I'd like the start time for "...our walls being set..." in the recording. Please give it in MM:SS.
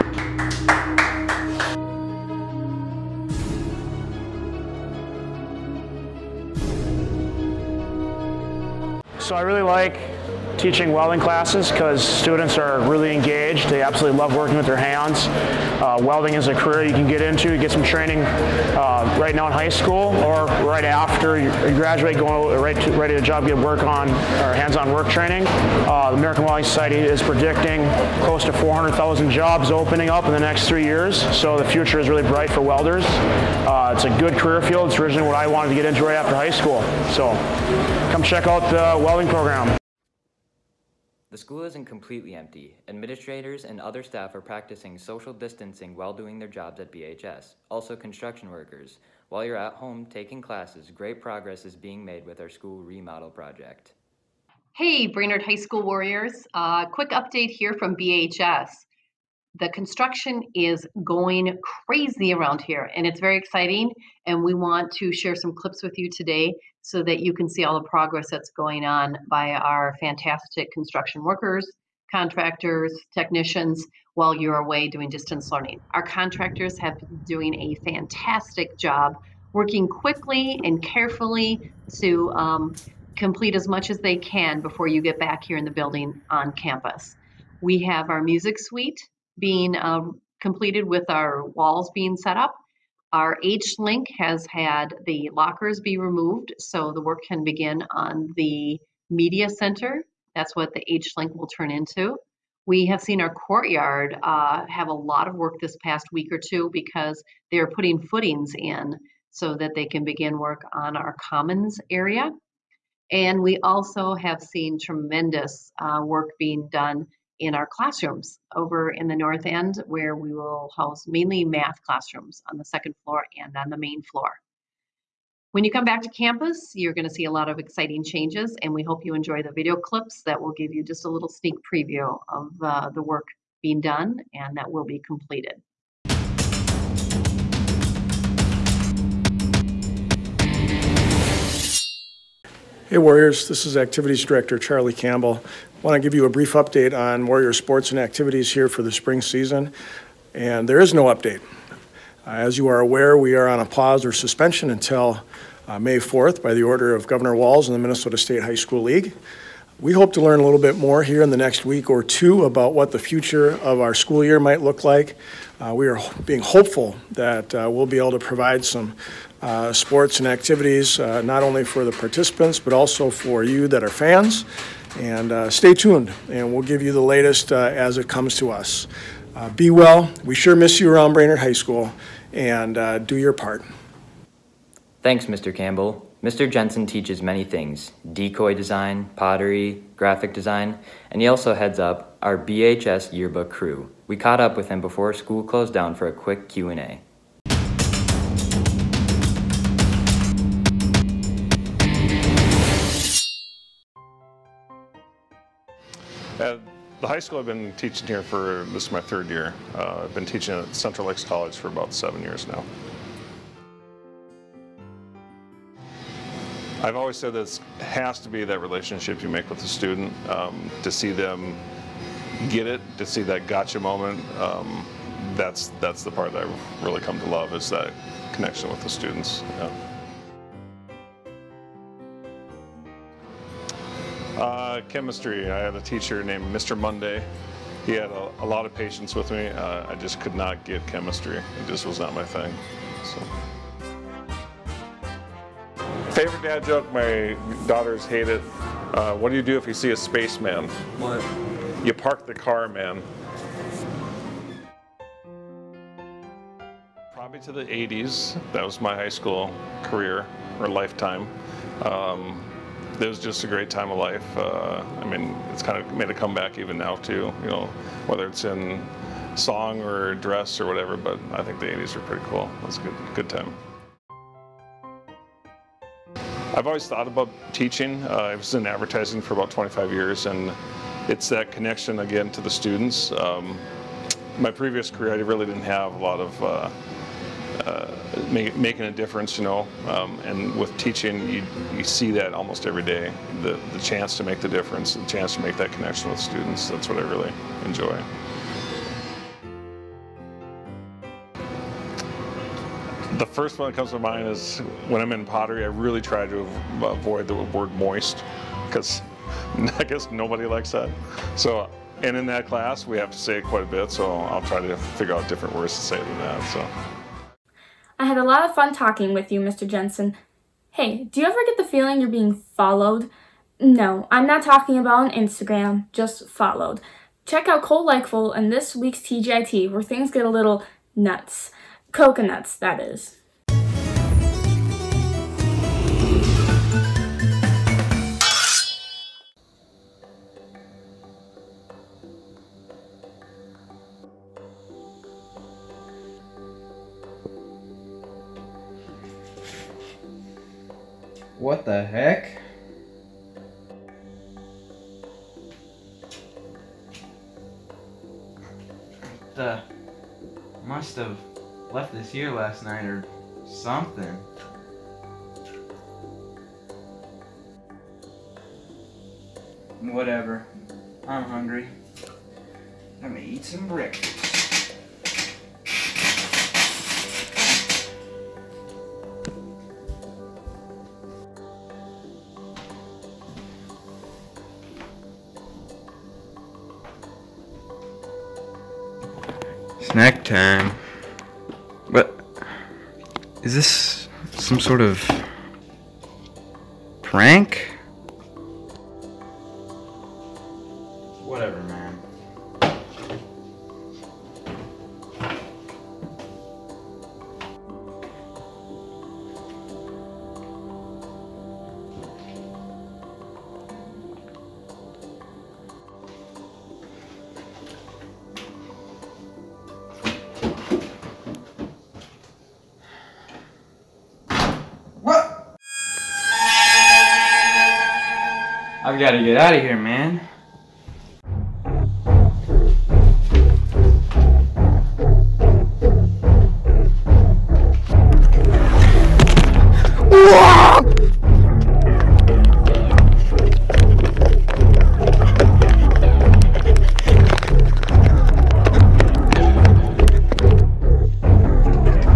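01:31.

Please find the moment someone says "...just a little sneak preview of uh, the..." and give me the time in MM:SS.
02:10.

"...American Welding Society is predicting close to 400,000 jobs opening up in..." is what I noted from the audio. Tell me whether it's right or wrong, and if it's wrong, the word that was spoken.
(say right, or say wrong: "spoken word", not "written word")
right.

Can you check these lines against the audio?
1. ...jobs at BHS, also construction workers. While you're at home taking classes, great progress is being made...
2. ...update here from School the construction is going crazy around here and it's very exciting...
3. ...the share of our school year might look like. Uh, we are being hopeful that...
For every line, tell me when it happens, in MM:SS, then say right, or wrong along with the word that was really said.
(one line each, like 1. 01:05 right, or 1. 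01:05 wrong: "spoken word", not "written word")
1. 00:46 right
2. 00:57 wrong: "BHS", not "School"
3. 02:42 wrong: "future", not "share".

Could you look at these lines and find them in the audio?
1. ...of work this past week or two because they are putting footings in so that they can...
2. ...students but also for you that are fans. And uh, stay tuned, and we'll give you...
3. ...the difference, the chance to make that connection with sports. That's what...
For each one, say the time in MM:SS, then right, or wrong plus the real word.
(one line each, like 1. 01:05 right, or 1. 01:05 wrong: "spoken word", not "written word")
1. 01:45 right
2. 02:51 wrong: "participants", not "students"
3. 04:54 wrong: "students", not "sports".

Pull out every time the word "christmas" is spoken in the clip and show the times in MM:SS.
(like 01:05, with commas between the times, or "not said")
not said.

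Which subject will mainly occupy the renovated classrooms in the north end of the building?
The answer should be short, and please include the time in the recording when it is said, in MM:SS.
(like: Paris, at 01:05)
math, at 02:01.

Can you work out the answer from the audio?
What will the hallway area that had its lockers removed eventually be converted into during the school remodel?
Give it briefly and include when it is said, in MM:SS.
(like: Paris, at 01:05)
media center, at 01:39.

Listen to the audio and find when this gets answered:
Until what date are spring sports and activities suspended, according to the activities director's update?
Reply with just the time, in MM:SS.
02:35.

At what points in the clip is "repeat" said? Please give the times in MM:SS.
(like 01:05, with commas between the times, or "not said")
not said.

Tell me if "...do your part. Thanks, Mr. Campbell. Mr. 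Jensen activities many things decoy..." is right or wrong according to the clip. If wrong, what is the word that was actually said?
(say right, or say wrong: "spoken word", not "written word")
wrong: "teaches", not "activities".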